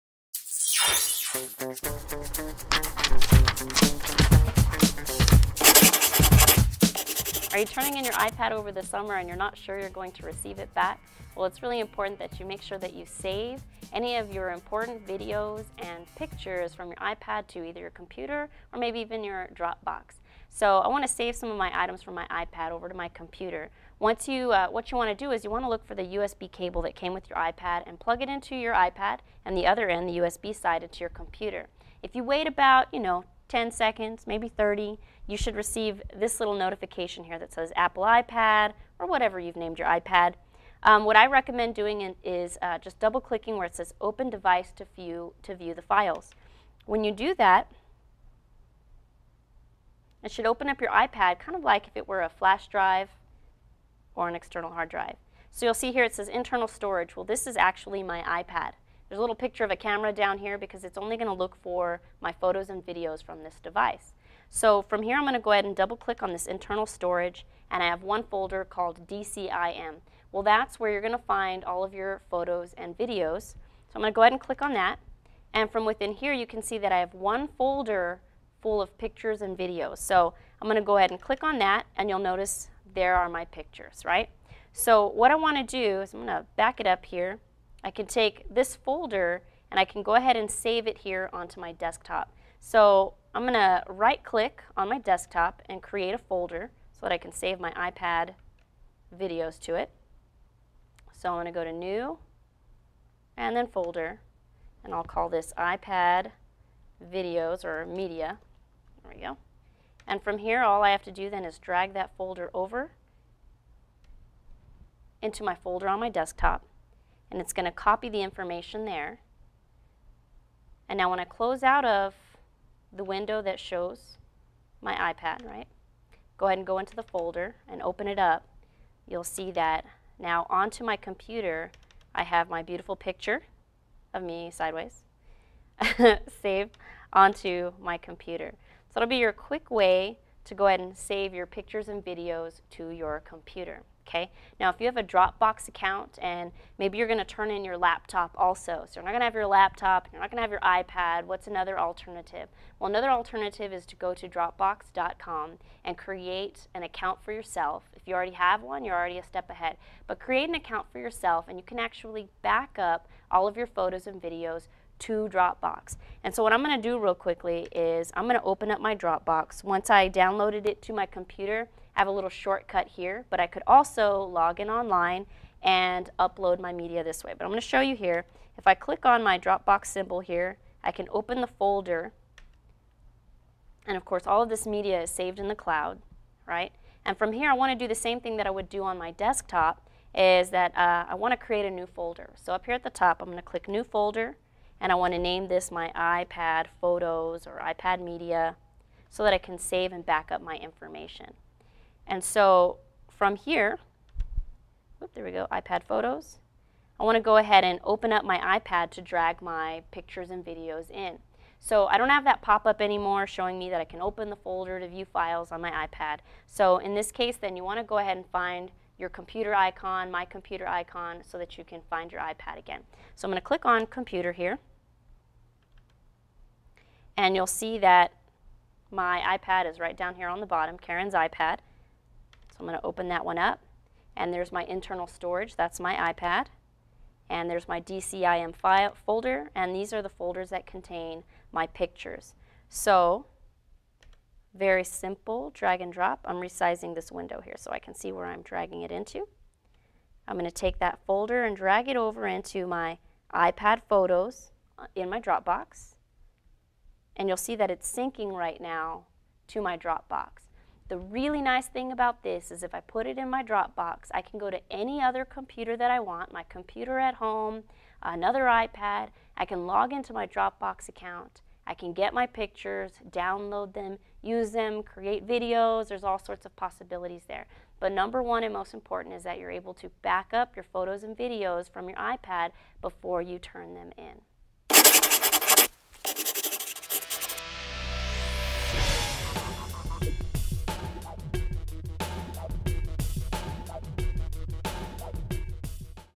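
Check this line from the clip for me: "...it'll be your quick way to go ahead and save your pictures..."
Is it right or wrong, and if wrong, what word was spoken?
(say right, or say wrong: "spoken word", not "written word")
right.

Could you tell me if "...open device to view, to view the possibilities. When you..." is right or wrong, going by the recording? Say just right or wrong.
wrong.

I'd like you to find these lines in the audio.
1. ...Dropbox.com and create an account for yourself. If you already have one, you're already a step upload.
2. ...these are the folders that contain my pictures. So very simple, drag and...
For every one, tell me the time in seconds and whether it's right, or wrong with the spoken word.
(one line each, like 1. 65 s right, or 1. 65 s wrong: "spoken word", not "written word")
1. 154 s wrong: "ahead", not "upload"
2. 239 s right.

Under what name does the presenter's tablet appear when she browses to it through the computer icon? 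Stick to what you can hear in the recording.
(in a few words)
Karen's iPad.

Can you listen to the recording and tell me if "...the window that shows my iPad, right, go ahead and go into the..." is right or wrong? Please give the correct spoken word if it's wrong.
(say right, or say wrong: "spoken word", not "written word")
right.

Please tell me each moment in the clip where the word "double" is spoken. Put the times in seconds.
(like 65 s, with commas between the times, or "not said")
43 s, 65 s.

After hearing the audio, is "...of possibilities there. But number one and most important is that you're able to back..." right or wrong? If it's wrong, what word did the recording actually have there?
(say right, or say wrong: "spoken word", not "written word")
right.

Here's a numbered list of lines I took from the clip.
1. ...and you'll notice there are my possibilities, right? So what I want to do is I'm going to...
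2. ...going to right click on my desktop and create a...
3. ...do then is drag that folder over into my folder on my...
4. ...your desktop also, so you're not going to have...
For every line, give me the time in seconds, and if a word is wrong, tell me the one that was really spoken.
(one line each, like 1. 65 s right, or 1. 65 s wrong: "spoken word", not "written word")
1. 81 s wrong: "pictures", not "possibilities"
2. 93 s right
3. 111 s right
4. 147 s wrong: "laptop", not "desktop".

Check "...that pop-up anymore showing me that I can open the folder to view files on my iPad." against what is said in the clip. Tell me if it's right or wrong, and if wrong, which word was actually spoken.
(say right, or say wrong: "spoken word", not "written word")
right.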